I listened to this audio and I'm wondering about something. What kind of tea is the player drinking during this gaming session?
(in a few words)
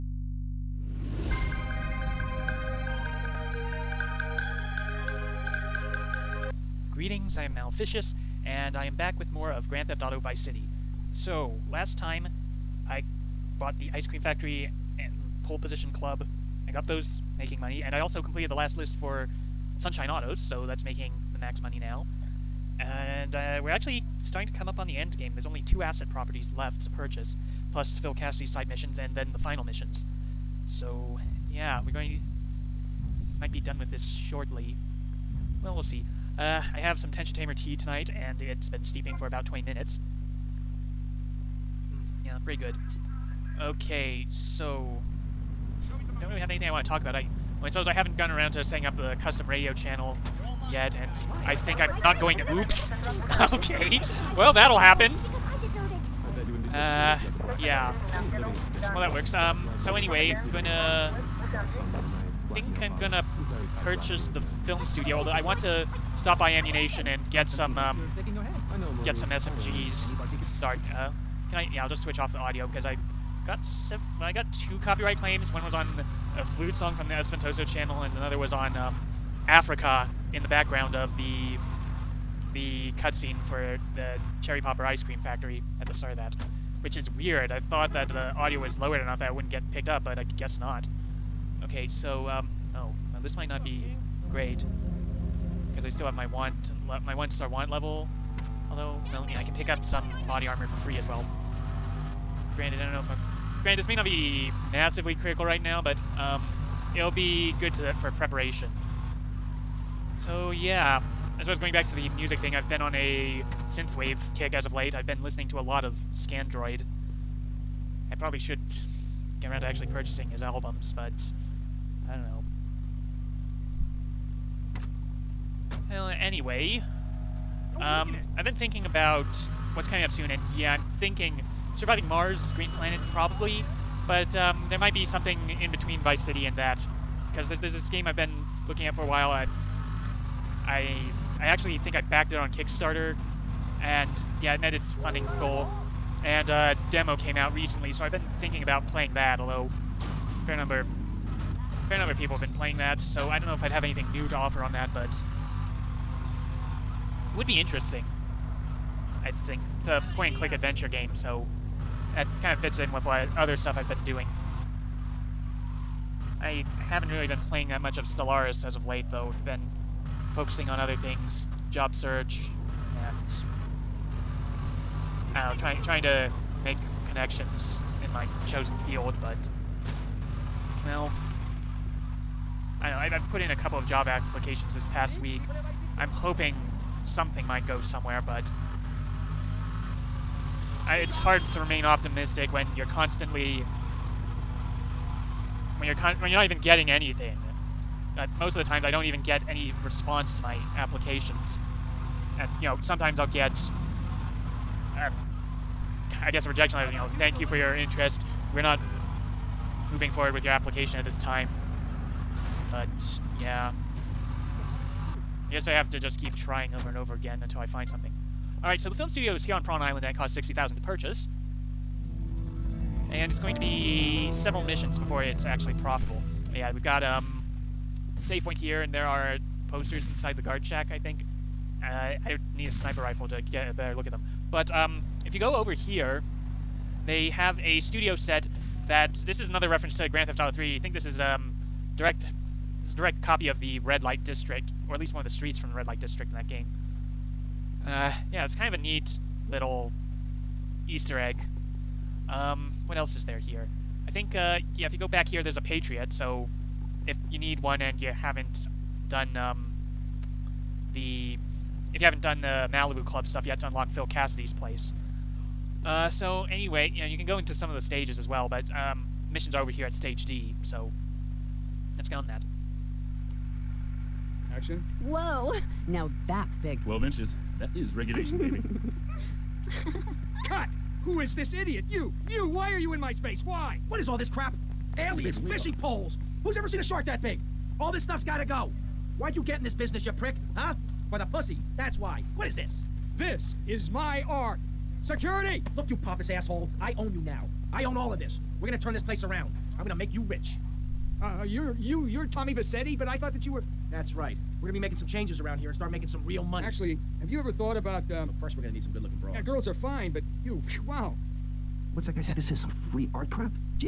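Tension Tamer.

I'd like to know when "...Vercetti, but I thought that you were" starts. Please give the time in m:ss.
5:02.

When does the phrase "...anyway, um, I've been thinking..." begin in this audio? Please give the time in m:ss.
2:06.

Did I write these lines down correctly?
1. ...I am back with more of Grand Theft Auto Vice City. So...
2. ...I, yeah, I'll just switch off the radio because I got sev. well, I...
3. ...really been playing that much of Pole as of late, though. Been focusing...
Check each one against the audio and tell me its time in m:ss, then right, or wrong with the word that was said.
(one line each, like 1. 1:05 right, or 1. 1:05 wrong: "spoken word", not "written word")
1. 0:08 right
2. 1:11 wrong: "audio", not "radio"
3. 2:47 wrong: "Stellaris", not "Pole".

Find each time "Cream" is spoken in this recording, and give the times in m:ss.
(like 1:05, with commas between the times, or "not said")
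0:14, 1:25.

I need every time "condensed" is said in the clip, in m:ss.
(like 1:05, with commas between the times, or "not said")
not said.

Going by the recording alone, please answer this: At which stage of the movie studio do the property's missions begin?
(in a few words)
stage D.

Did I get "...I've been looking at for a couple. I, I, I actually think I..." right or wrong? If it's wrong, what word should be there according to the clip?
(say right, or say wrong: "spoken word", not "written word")
wrong: "while", not "couple".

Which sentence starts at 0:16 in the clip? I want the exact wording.
I got those making money, and I also completed the last list for Sunshine Autos, so that's making the max money now.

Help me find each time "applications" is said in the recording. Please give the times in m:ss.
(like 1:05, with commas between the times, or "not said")
3:04, 3:20, 3:30.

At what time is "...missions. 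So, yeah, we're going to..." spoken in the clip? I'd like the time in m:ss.
0:29.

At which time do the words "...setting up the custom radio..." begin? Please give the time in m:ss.
0:48.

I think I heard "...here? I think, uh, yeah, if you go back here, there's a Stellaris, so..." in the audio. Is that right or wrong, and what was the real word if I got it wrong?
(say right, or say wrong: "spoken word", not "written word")
wrong: "Patriot", not "Stellaris".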